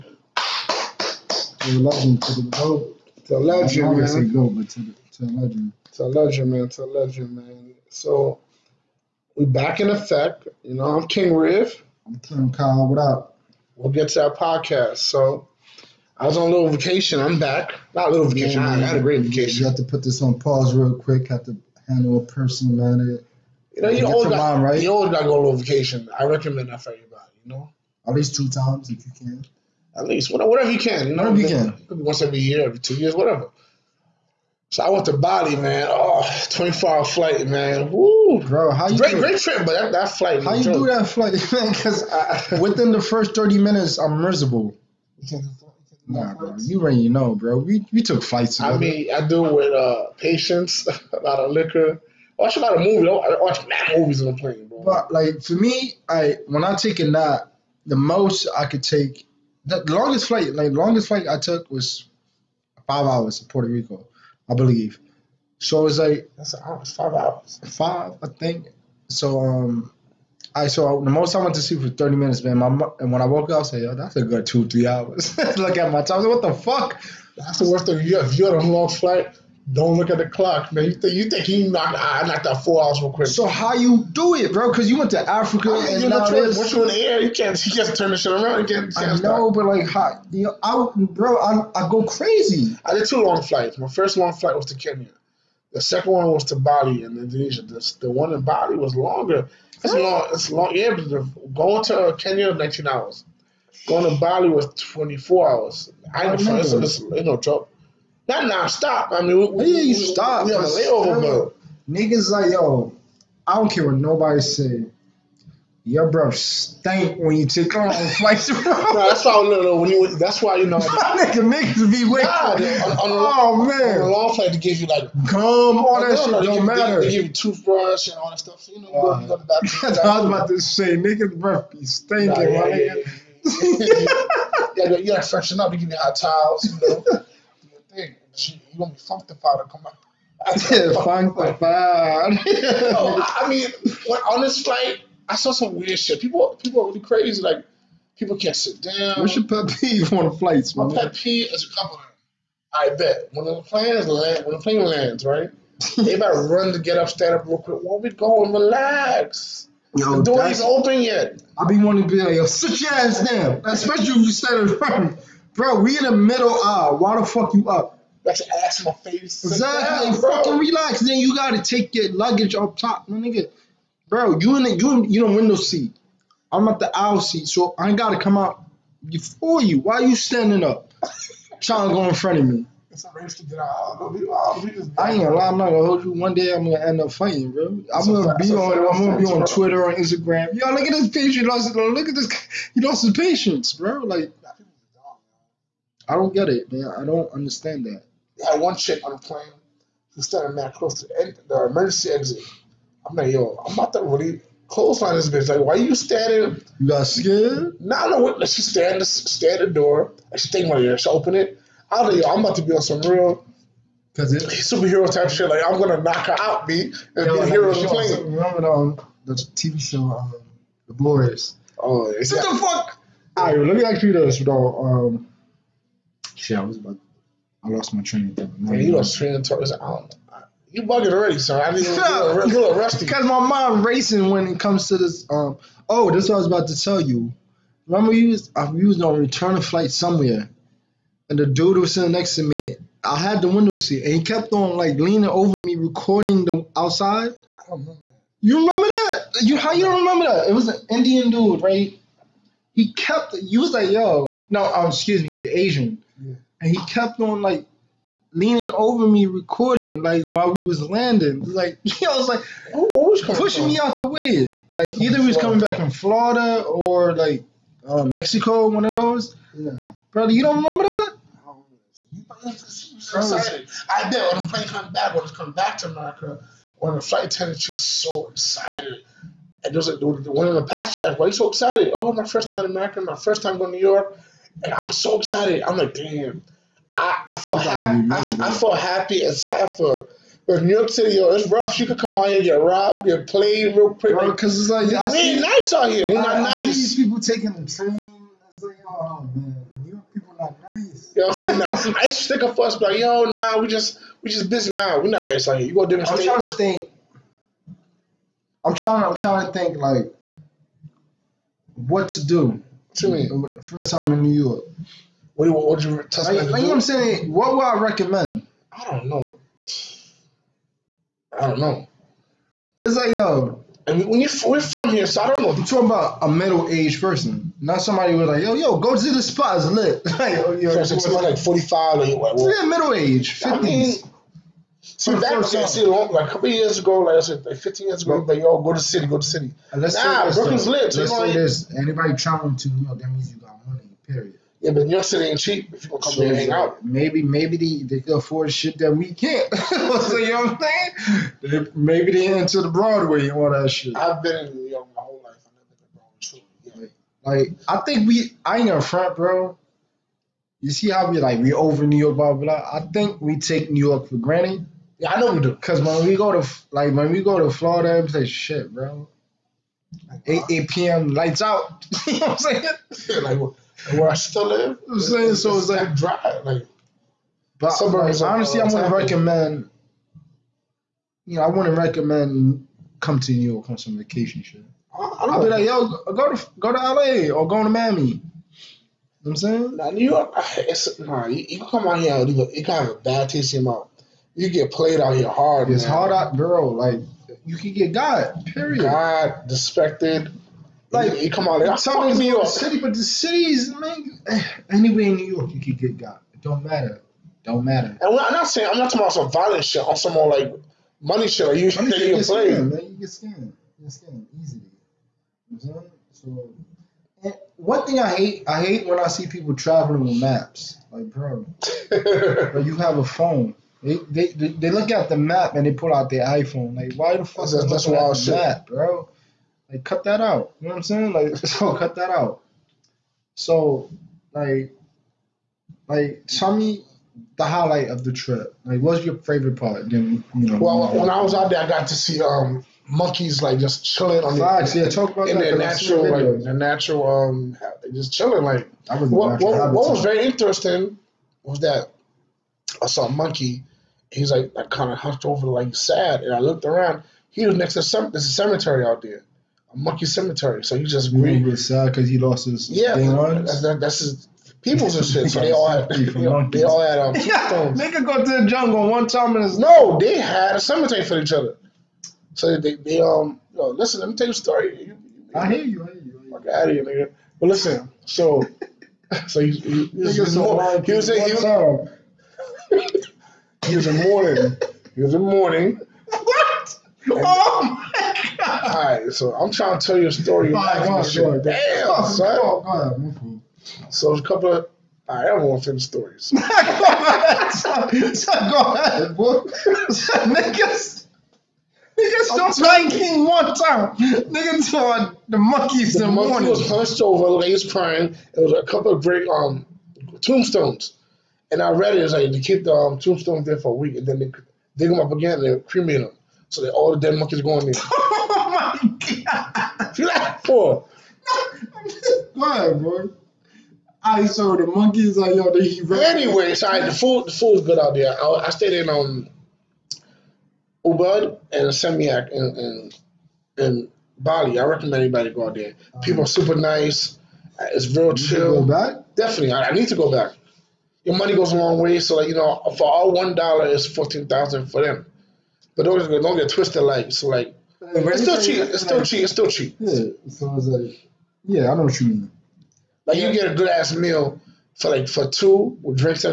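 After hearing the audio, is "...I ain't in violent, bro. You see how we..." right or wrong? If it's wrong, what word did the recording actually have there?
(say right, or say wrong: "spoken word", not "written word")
wrong: "front", not "violent".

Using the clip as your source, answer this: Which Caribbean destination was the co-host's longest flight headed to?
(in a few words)
Puerto Rico.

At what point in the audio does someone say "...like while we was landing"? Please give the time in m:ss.
4:20.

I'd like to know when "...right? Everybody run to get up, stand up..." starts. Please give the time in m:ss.
2:35.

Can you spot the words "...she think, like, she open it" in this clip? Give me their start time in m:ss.
3:30.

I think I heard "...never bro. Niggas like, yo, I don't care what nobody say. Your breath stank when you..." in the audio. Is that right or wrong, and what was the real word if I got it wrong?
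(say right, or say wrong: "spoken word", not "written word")
wrong: "layover", not "never".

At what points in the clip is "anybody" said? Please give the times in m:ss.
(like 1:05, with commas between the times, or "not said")
5:41, 8:55.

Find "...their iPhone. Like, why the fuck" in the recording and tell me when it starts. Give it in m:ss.
7:06.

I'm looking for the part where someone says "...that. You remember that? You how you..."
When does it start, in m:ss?
4:08.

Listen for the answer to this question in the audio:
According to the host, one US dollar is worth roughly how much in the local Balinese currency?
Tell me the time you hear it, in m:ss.
9:03.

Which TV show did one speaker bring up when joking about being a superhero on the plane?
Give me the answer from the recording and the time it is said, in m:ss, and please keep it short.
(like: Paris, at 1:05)
The Boys, at 3:40.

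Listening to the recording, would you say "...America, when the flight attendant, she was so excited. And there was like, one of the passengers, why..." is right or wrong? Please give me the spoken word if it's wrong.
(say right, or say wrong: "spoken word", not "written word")
right.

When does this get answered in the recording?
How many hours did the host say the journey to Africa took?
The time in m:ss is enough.
1:42.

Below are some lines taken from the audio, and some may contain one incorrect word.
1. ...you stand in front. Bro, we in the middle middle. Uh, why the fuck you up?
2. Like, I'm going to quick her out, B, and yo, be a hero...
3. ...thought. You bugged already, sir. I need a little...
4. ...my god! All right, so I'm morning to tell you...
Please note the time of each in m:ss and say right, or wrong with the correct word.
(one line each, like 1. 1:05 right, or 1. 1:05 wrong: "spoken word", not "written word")
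1. 2:44 wrong: "aisle", not "middle"
2. 3:35 wrong: "knock", not "quick"
3. 3:49 right
4. 8:07 wrong: "trying", not "morning".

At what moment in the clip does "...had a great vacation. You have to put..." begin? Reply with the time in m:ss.
0:18.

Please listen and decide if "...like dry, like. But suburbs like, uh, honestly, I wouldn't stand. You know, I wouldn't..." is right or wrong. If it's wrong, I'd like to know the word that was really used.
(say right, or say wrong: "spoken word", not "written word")
wrong: "recommend", not "stand".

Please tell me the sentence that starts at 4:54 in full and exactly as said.
Bro, because it's like, yeah, we ain't nice out here.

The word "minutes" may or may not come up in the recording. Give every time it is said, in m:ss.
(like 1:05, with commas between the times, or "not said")
0:43, 1:12.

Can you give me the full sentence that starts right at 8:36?
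So that all the dead monkeys going in.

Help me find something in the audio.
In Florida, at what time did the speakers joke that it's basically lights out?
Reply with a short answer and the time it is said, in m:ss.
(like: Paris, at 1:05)
8 p.m., at 6:10.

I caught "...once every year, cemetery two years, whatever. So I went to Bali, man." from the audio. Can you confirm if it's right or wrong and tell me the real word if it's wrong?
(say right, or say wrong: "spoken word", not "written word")
wrong: "every", not "cemetery".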